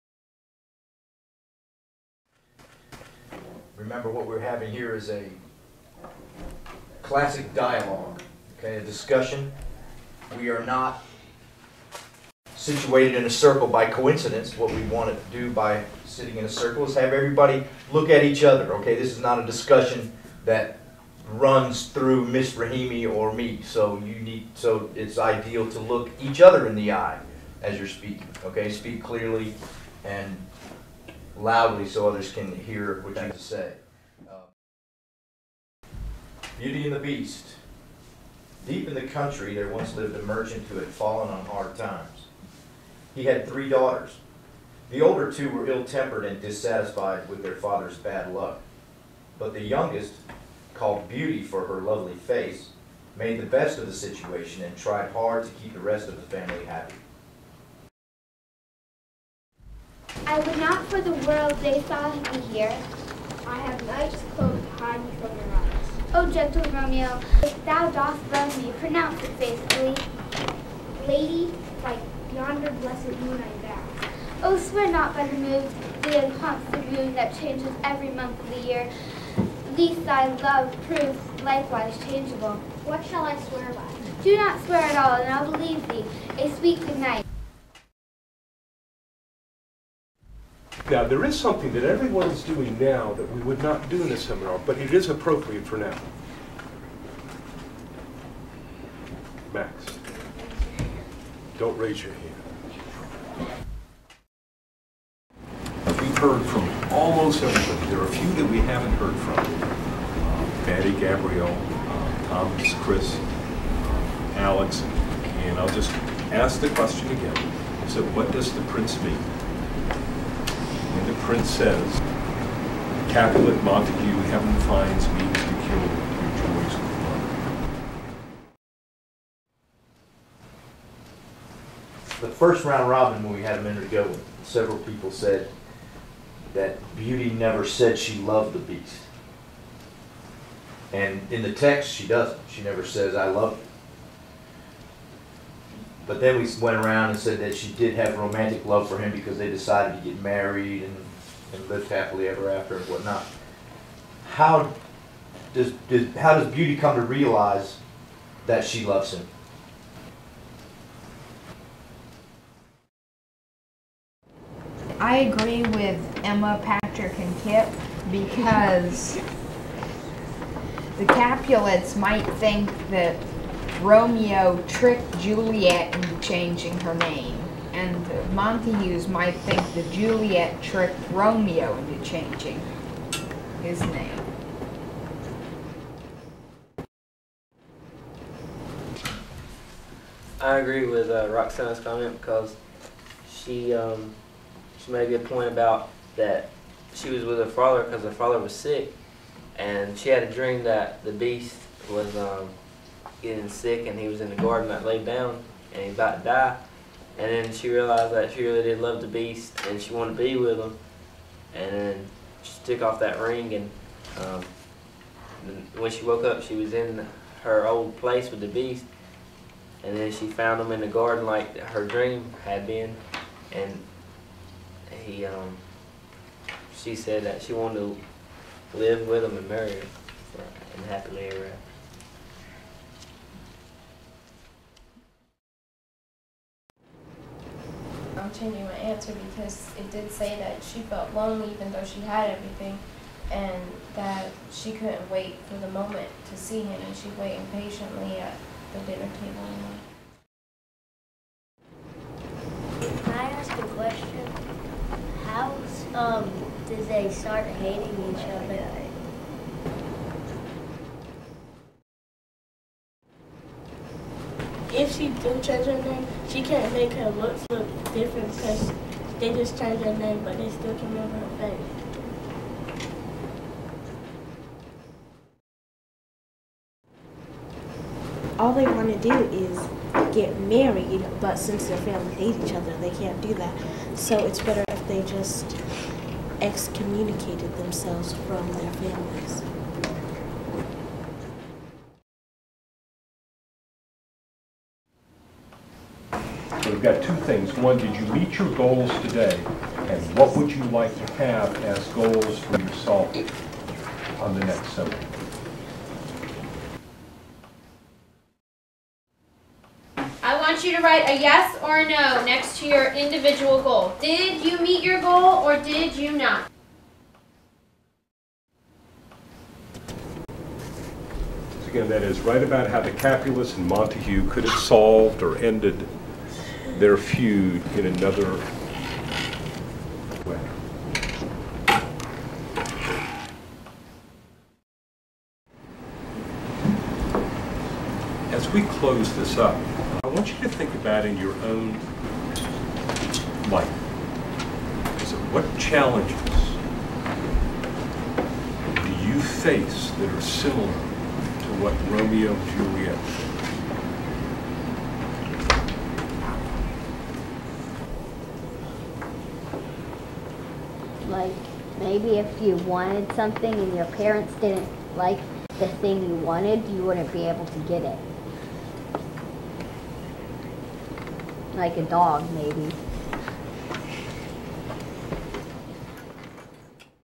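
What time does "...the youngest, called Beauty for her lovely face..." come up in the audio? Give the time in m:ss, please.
0:49.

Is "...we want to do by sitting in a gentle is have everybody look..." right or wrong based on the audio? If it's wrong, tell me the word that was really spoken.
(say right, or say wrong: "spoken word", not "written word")
wrong: "circle", not "gentle".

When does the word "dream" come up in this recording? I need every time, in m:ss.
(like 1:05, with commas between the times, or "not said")
3:20, 3:41.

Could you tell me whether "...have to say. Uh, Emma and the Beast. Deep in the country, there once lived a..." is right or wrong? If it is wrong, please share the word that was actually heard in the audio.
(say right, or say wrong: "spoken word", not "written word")
wrong: "Beauty", not "Emma".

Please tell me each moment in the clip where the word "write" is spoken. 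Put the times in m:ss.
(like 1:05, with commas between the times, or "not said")
5:10, 5:22.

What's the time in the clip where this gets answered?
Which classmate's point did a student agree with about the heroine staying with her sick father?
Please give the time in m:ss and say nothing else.
3:11.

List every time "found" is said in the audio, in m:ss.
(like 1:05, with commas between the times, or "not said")
3:40.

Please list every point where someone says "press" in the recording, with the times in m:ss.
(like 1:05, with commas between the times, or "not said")
not said.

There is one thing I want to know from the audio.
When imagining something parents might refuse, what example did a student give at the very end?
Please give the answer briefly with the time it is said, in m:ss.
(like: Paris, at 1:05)
a dog, at 6:11.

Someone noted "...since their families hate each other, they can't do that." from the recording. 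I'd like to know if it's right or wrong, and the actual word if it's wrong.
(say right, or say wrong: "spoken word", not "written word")
right.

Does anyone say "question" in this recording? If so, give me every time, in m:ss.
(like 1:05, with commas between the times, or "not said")
1:56, 4:13.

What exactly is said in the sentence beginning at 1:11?
Lady, like yonder blessed moon I vow.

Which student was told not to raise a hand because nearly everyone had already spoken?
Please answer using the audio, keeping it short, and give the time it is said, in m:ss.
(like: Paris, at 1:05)
Max, at 1:39.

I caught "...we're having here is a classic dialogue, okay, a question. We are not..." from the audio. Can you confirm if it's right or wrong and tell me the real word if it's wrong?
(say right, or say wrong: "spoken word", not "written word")
wrong: "discussion", not "question".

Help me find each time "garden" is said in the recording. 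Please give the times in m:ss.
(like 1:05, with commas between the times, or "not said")
3:24, 3:40.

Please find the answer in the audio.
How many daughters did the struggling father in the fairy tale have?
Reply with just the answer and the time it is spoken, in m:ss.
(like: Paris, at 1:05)
3, at 0:43.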